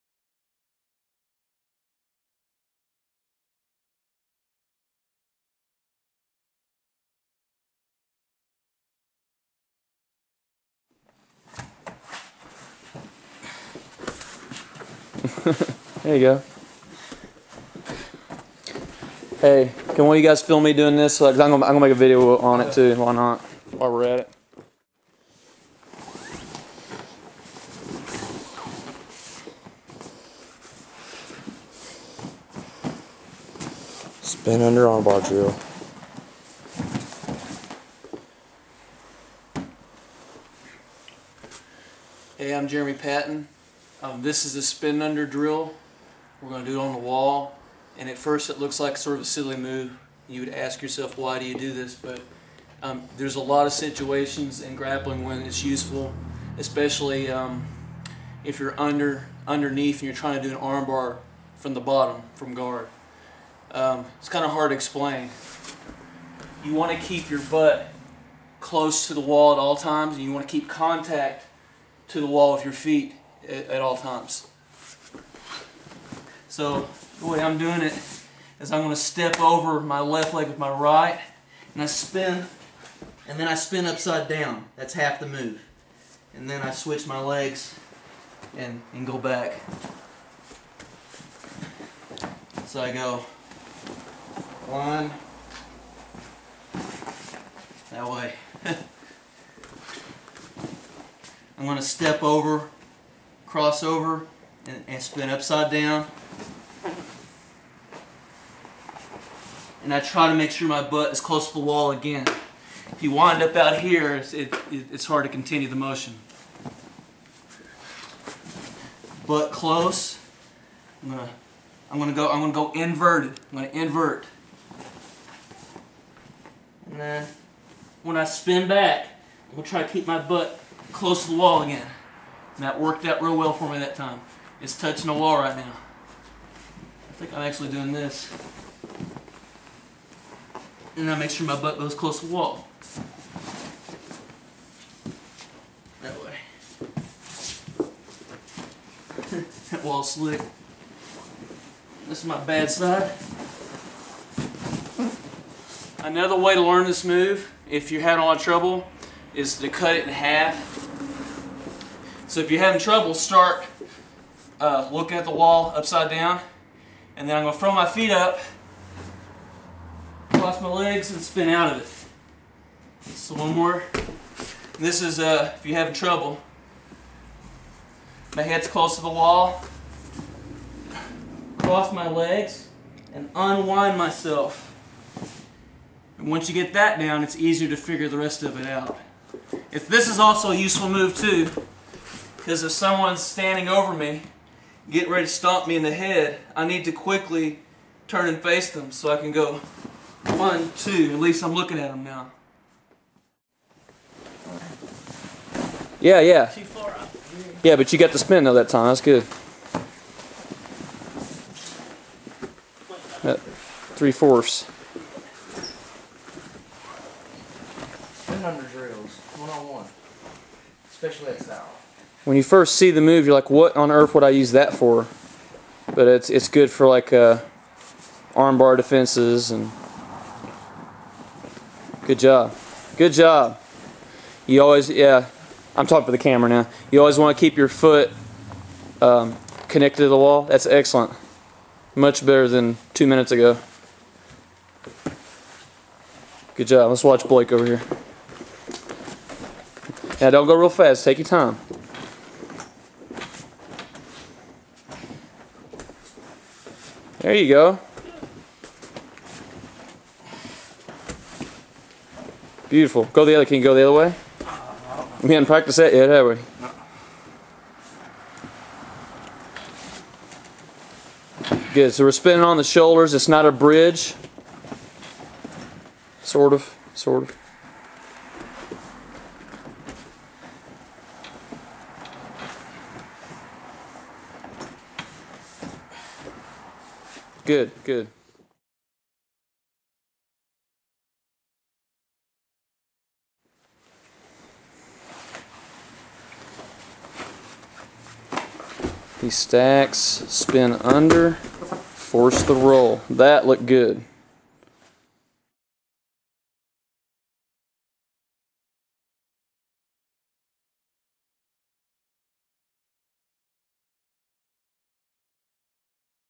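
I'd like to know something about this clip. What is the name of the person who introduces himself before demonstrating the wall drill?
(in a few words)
Jeremy Patton.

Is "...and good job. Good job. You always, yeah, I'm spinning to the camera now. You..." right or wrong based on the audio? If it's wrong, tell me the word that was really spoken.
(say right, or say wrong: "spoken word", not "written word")
wrong: "talking", not "spinning".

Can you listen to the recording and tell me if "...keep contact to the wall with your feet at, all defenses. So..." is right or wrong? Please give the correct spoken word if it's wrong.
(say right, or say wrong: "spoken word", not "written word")
wrong: "times", not "defenses".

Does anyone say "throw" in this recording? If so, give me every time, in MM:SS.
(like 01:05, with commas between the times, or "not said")
02:47.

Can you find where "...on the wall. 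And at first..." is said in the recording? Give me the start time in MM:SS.
00:46.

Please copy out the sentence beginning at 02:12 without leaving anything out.
And that worked out real well for me that time.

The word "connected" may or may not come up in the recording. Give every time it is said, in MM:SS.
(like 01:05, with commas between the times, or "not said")
03:59.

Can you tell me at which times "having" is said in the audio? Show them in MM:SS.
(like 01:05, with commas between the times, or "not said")
02:38, 02:42, 02:55.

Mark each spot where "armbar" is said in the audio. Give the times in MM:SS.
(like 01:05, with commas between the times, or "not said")
00:34, 01:00, 03:48.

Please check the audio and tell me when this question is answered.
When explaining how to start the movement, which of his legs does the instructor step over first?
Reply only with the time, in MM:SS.
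01:19.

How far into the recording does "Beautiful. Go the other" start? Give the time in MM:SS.
04:22.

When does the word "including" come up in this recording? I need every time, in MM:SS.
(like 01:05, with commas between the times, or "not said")
not said.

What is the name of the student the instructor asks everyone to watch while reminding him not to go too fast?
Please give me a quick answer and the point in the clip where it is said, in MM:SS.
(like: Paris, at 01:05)
Blake, at 04:07.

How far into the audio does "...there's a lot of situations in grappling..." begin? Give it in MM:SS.
00:53.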